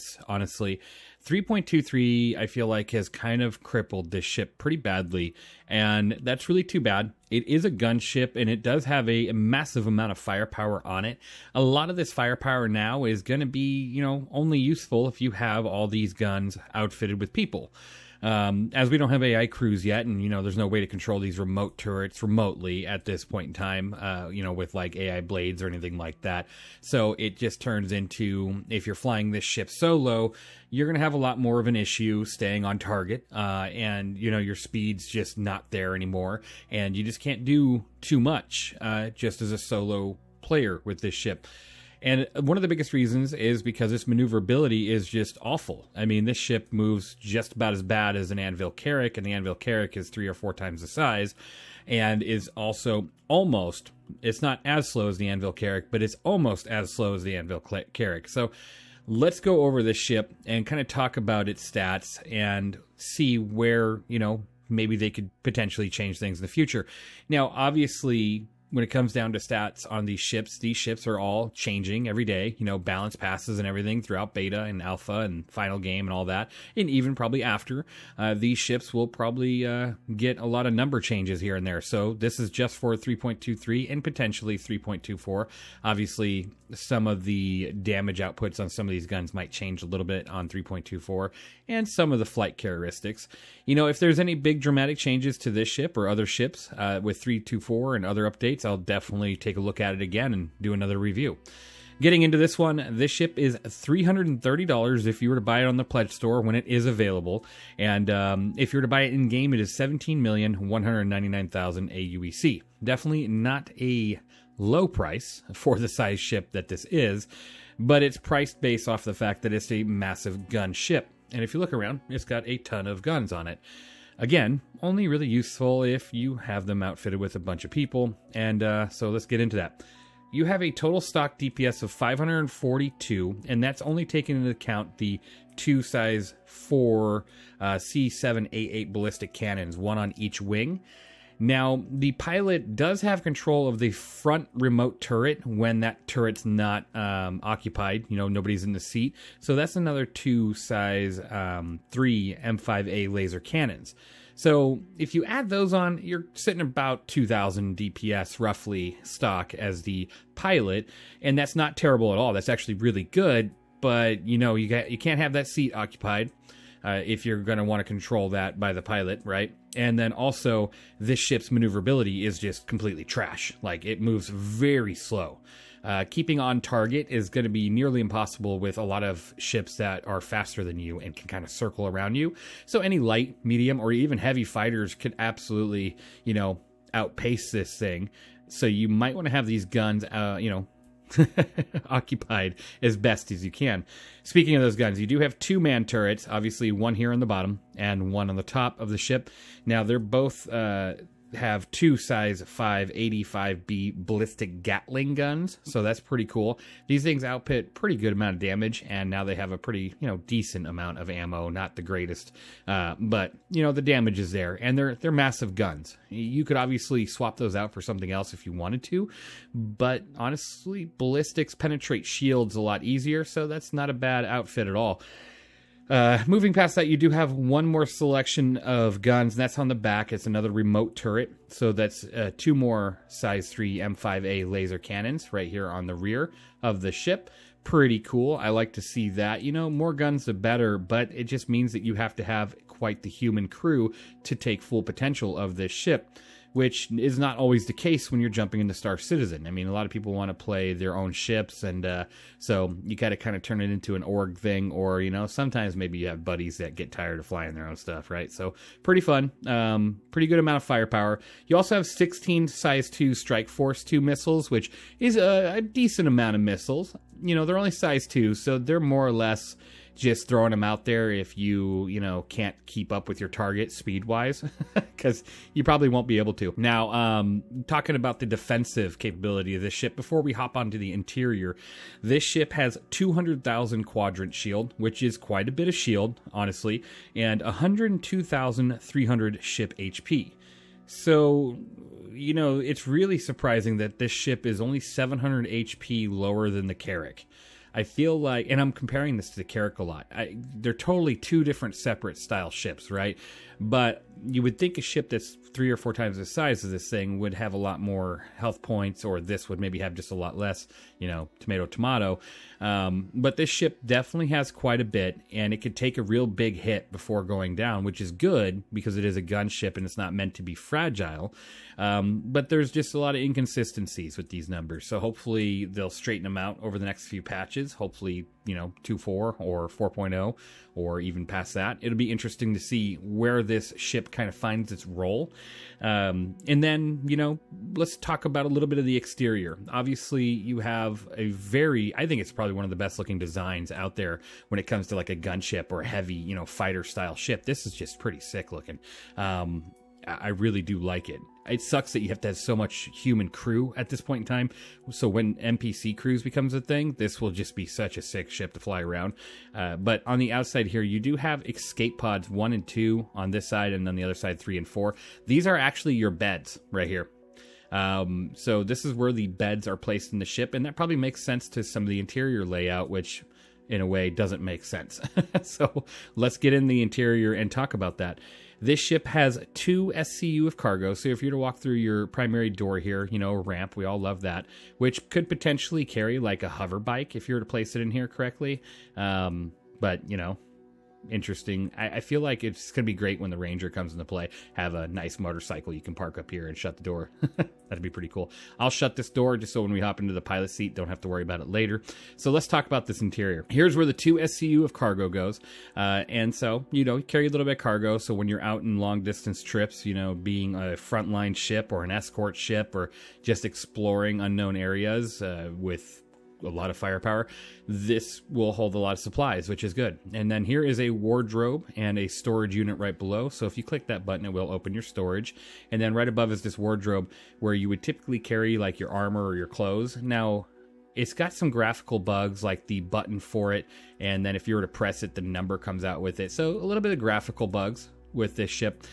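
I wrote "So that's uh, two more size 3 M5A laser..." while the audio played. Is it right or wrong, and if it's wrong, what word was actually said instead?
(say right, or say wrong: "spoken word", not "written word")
right.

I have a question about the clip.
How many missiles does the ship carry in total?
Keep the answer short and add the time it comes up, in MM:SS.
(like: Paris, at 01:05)
16, at 04:21.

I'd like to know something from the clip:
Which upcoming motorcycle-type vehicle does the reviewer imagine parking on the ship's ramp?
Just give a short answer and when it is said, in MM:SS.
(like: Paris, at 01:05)
Ranger, at 06:33.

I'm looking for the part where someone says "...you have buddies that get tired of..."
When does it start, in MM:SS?
04:15.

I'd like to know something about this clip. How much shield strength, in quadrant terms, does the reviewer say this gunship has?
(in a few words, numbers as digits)
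200,000.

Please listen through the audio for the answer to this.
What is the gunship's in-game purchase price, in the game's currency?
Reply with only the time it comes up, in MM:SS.
01:49.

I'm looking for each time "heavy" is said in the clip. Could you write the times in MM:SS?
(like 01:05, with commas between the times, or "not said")
03:04, 05:45.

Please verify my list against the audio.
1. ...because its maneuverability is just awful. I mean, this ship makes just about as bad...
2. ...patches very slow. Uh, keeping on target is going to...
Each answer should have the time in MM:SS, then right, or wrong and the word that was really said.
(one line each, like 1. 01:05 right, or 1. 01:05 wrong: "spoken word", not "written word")
1. 00:43 wrong: "moves", not "makes"
2. 02:54 wrong: "moves", not "patches".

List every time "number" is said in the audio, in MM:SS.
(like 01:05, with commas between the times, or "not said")
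01:20, 05:24, 07:15.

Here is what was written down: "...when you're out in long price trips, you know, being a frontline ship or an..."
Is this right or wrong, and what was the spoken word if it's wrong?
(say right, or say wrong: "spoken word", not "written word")
wrong: "distance", not "price".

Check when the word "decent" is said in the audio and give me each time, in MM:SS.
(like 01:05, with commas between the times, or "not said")
03:30, 04:25.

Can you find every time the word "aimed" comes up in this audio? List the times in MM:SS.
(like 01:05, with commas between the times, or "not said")
not said.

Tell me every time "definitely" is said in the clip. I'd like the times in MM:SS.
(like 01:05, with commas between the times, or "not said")
01:38, 01:52, 05:13.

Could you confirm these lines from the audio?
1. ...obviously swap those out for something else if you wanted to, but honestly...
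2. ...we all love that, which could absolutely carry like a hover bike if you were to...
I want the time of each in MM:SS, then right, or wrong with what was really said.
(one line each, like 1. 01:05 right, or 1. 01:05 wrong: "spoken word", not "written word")
1. 03:36 right
2. 06:23 wrong: "potentially", not "absolutely".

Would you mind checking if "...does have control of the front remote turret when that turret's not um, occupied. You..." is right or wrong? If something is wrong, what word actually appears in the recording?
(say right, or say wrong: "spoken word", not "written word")
right.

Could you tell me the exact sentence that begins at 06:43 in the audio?
Here's where the two SCU of cargo goes.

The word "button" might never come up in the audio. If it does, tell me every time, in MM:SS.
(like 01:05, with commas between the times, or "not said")
07:04, 07:12.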